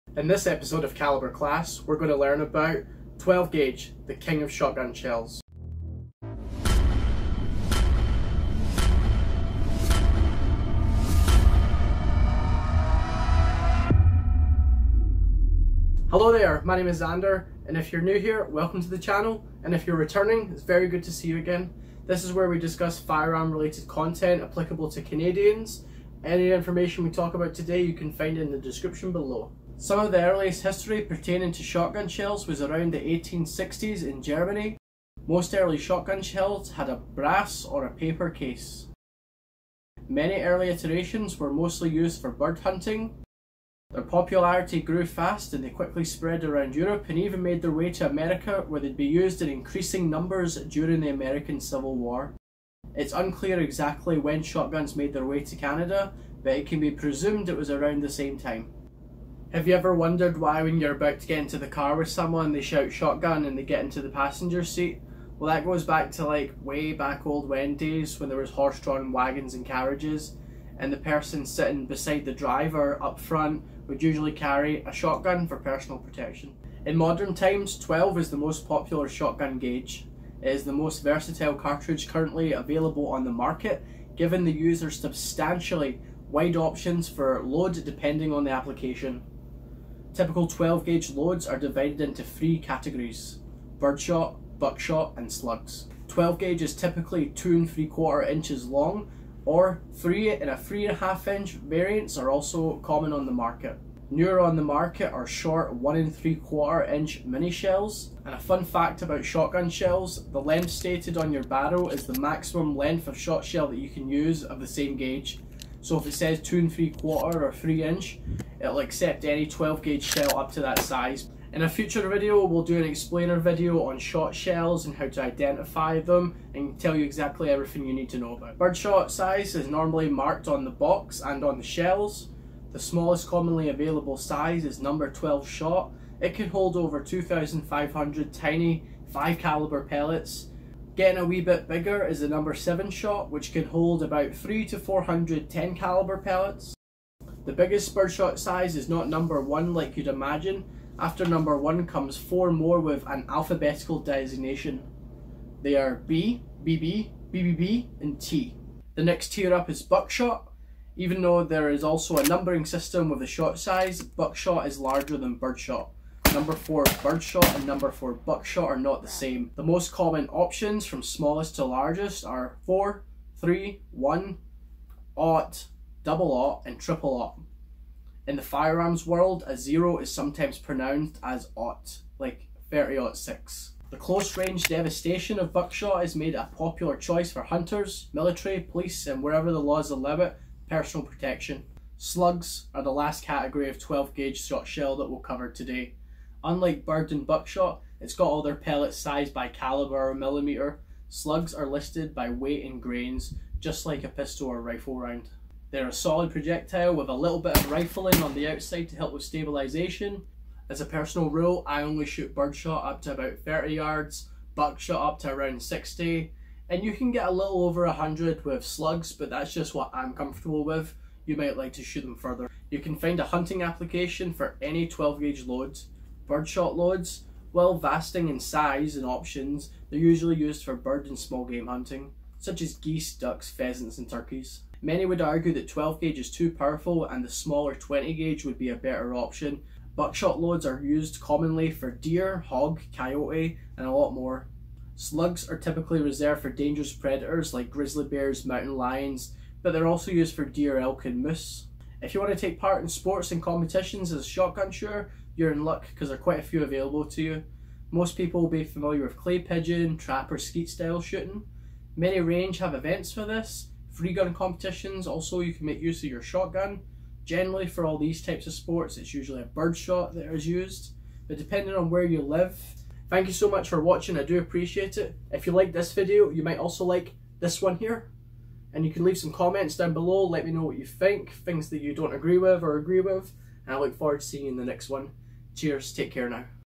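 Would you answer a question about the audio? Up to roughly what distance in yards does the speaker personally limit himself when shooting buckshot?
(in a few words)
60 yards.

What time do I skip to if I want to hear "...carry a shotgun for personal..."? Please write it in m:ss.
1:14.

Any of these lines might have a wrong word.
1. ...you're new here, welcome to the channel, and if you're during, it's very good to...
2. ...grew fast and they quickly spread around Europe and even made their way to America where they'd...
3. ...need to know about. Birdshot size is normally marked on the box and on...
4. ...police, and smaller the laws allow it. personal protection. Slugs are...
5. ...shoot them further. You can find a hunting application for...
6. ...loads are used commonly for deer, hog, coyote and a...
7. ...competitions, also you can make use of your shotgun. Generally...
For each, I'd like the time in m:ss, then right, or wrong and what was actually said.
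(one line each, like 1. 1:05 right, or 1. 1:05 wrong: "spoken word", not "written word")
1. 0:17 wrong: "returning", not "during"
2. 0:44 right
3. 2:07 right
4. 3:08 wrong: "wherever", not "smaller"
5. 3:41 right
6. 4:00 right
7. 4:24 right.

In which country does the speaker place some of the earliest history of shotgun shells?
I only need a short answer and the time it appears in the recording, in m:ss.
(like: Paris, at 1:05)
Germany, at 0:34.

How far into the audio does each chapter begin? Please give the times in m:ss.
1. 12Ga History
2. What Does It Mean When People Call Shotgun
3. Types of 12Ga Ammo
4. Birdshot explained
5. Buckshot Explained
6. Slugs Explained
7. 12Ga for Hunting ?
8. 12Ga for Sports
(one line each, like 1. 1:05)
1. 0:15
2. 0:59
3. 1:30
4. 2:09
5. 2:39
6. 3:11
7. 3:41
8. 4:11.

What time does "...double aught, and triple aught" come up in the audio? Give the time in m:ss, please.
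2:56.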